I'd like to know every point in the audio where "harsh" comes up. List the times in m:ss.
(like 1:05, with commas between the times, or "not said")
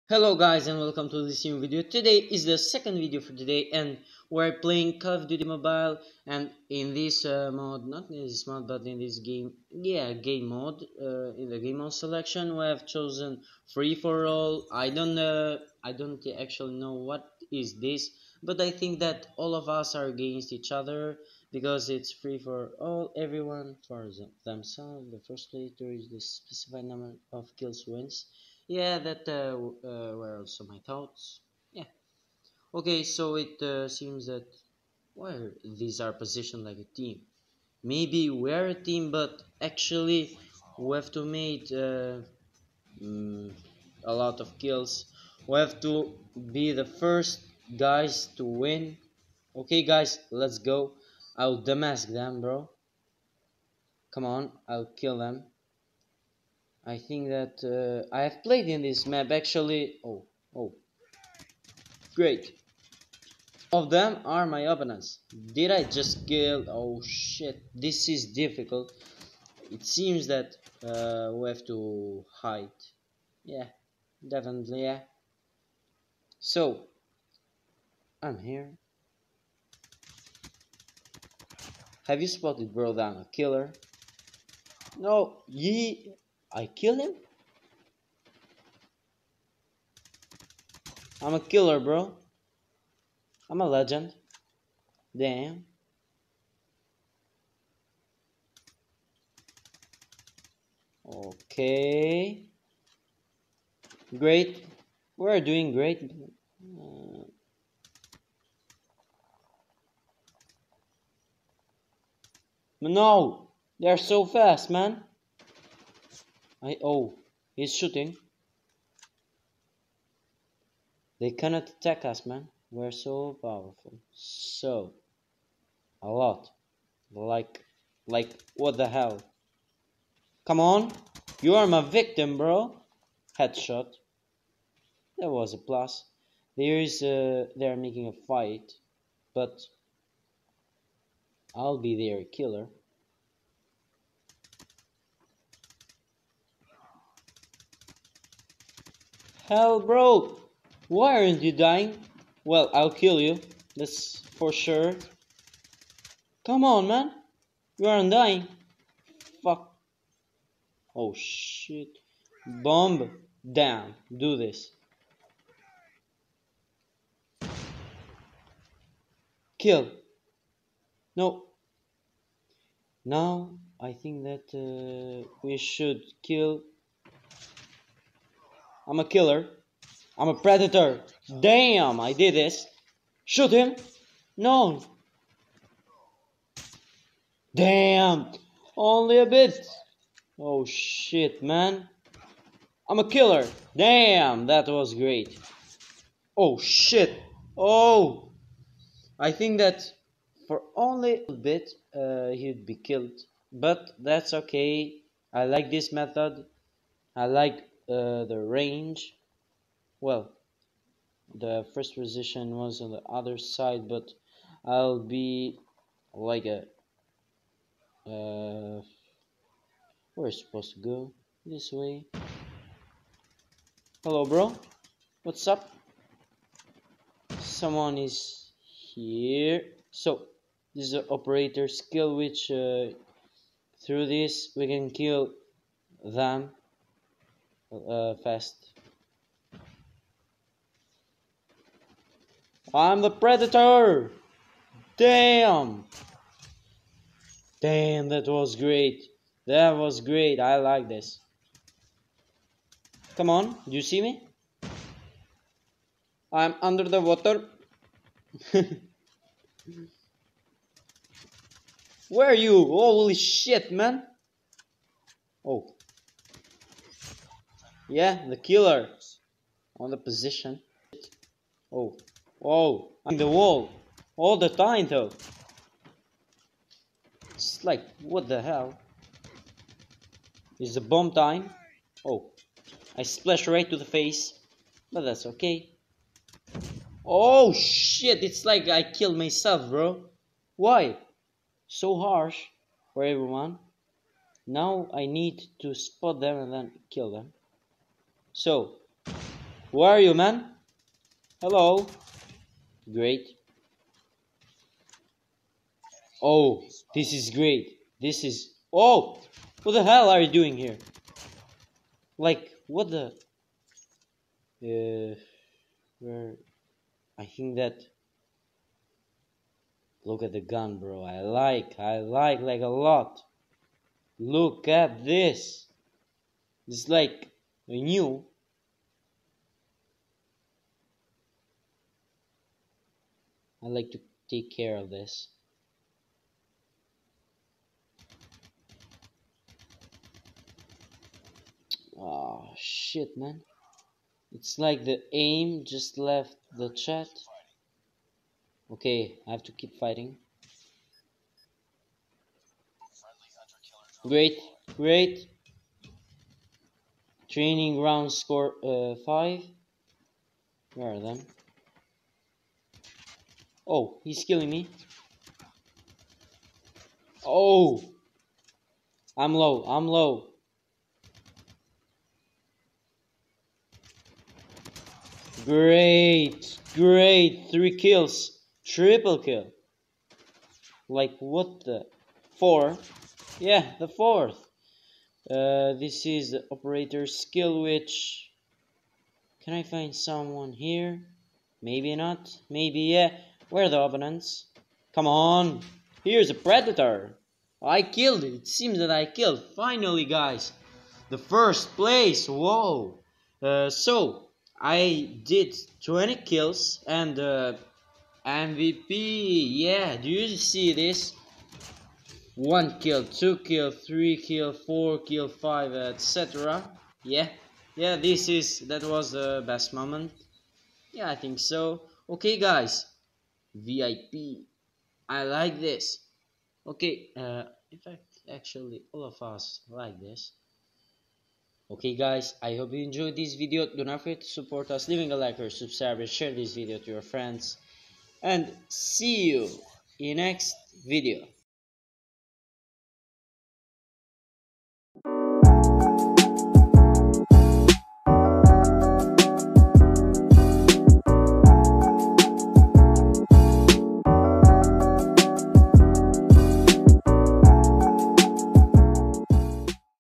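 4:51.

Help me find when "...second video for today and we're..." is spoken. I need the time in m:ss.
0:02.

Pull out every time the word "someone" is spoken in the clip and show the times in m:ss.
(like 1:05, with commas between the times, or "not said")
3:47, 6:29.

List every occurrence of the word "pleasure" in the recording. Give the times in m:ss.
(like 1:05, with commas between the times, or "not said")
not said.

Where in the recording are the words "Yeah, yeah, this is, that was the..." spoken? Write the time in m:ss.
6:57.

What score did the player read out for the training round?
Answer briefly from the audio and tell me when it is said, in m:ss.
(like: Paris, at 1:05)
5, at 5:58.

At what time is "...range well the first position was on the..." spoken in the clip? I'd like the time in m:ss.
3:28.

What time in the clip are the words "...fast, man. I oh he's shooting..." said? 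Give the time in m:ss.
1:54.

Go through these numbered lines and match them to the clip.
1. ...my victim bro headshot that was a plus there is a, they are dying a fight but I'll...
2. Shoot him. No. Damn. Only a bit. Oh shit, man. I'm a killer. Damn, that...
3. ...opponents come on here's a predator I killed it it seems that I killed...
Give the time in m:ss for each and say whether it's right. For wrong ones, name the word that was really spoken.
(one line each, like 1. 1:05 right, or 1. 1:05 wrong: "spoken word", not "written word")
1. 2:11 wrong: "making", not "dying"
2. 3:03 right
3. 6:33 right.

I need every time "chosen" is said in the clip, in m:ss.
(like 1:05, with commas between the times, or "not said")
0:12.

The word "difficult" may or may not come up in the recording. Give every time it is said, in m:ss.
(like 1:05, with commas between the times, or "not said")
1:08.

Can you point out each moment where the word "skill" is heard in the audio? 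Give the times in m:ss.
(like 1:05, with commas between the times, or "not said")
3:51, 6:27.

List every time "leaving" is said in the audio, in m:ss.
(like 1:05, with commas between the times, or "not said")
7:14.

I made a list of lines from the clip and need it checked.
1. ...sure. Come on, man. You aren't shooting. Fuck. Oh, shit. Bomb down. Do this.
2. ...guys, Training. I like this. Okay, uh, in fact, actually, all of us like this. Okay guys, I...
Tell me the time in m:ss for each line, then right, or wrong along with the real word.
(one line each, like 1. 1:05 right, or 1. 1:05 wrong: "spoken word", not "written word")
1. 2:34 wrong: "dying", not "shooting"
2. 7:02 wrong: "VIP", not "Training".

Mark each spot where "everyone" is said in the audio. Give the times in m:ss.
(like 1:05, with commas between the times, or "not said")
0:23, 4:53.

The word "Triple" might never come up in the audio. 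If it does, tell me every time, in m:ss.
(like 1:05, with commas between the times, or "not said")
6:18.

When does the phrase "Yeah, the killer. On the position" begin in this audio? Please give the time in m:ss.
4:27.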